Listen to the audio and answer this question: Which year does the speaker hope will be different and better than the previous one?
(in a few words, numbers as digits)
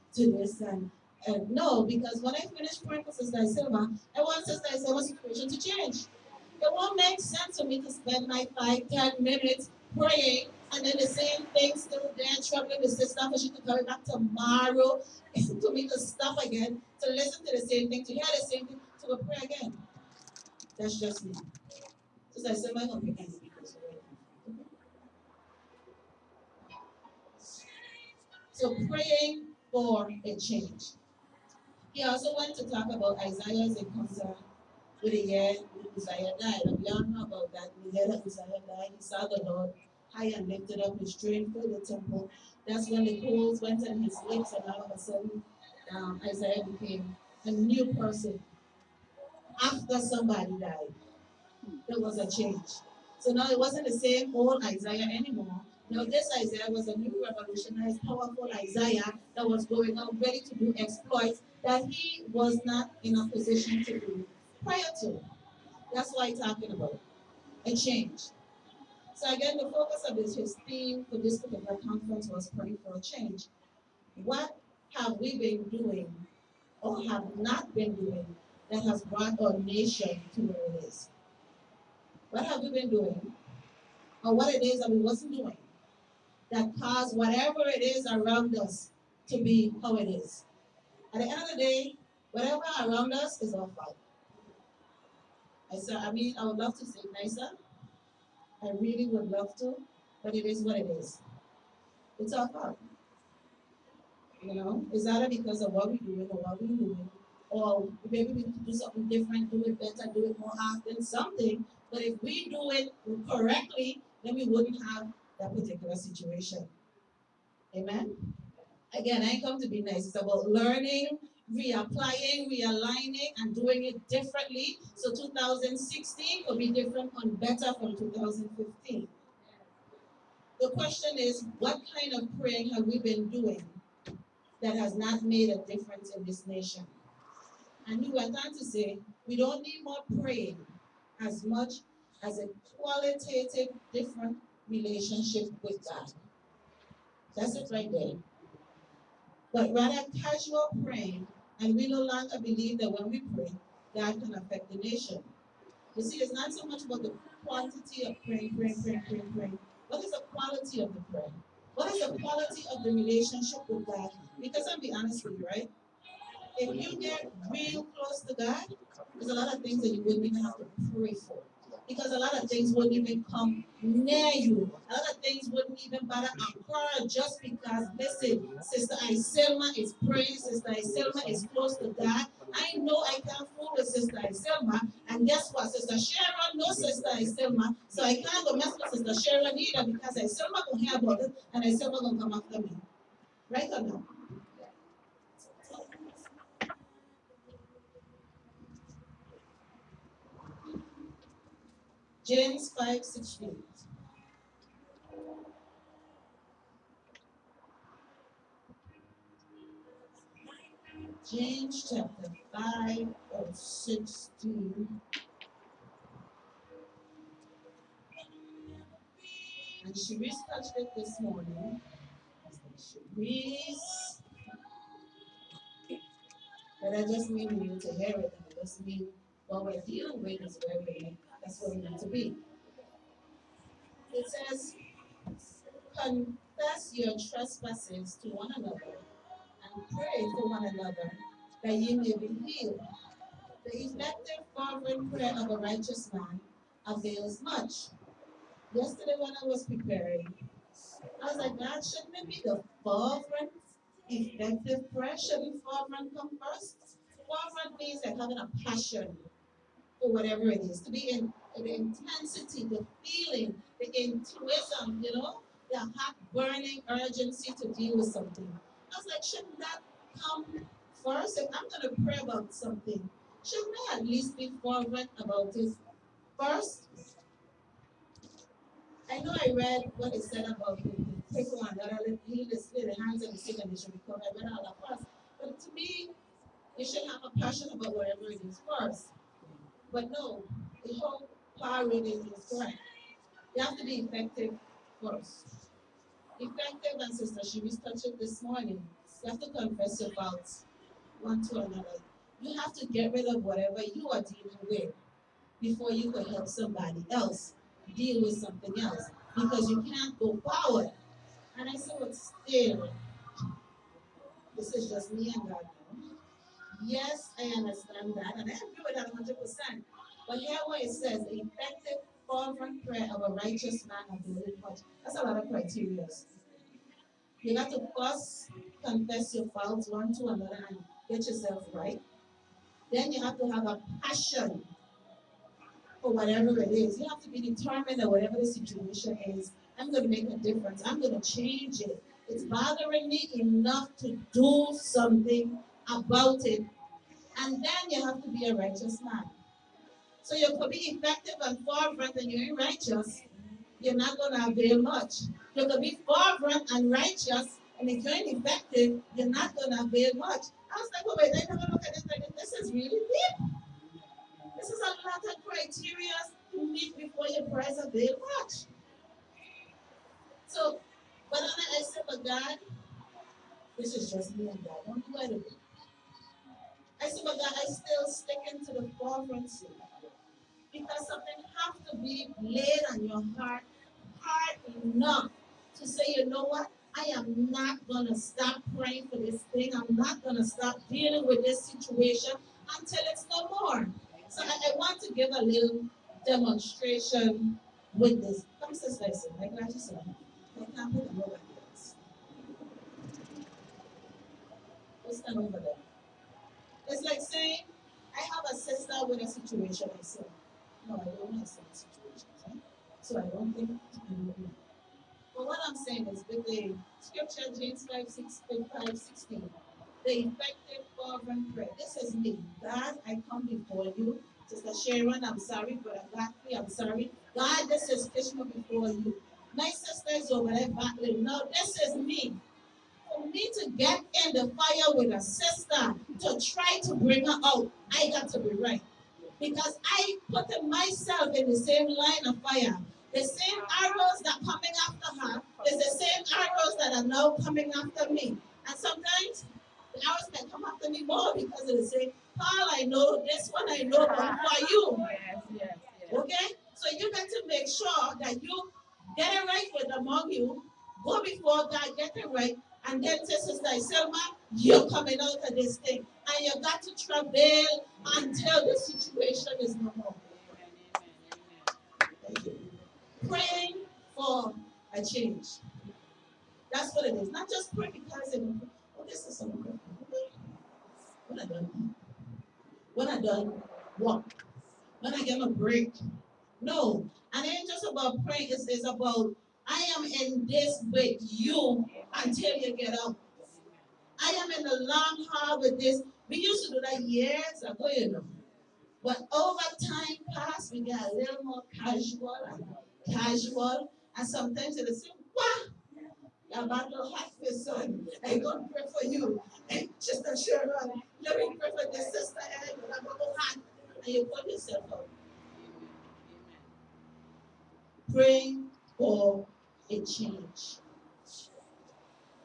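2016.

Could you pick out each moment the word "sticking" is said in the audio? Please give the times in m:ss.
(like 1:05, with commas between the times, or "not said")
6:18.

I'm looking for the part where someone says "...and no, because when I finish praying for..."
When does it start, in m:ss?
0:01.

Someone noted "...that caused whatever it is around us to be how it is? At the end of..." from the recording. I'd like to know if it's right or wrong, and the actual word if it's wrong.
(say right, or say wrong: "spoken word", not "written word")
right.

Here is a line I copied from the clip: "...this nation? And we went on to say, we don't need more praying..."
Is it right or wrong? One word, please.
right.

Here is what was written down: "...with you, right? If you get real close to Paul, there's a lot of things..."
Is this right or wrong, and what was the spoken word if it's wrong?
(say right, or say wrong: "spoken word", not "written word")
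wrong: "God", not "Paul".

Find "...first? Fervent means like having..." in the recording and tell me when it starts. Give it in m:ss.
4:16.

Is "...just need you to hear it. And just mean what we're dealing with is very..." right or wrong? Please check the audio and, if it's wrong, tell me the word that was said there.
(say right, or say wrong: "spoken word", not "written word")
right.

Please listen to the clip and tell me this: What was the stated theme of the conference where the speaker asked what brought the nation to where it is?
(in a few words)
peripheral change.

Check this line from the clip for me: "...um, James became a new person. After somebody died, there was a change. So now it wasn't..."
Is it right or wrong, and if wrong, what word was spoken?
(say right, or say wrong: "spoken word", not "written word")
wrong: "Isaiah", not "James".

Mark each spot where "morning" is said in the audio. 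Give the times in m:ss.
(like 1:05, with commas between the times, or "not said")
3:41, 4:58.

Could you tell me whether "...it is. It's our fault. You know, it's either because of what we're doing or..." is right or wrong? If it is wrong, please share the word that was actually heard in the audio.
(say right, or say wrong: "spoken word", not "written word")
right.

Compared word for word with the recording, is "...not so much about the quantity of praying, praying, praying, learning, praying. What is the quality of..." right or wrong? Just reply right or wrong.
wrong.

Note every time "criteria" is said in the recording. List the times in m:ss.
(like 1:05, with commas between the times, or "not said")
5:25, 6:05.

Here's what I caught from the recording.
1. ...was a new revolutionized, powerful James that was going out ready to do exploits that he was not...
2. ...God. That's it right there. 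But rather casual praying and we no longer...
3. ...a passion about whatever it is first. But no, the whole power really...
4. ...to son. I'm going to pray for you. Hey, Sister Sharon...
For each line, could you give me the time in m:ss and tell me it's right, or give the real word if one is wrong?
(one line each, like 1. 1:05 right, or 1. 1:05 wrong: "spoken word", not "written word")
1. 0:56 wrong: "Isaiah", not "James"
2. 2:25 right
3. 4:47 right
4. 8:26 right.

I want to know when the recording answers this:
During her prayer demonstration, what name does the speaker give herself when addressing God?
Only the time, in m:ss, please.
7:08.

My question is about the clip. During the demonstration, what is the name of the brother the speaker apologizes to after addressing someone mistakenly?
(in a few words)
Godfrey.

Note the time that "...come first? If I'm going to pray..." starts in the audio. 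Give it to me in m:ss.
4:30.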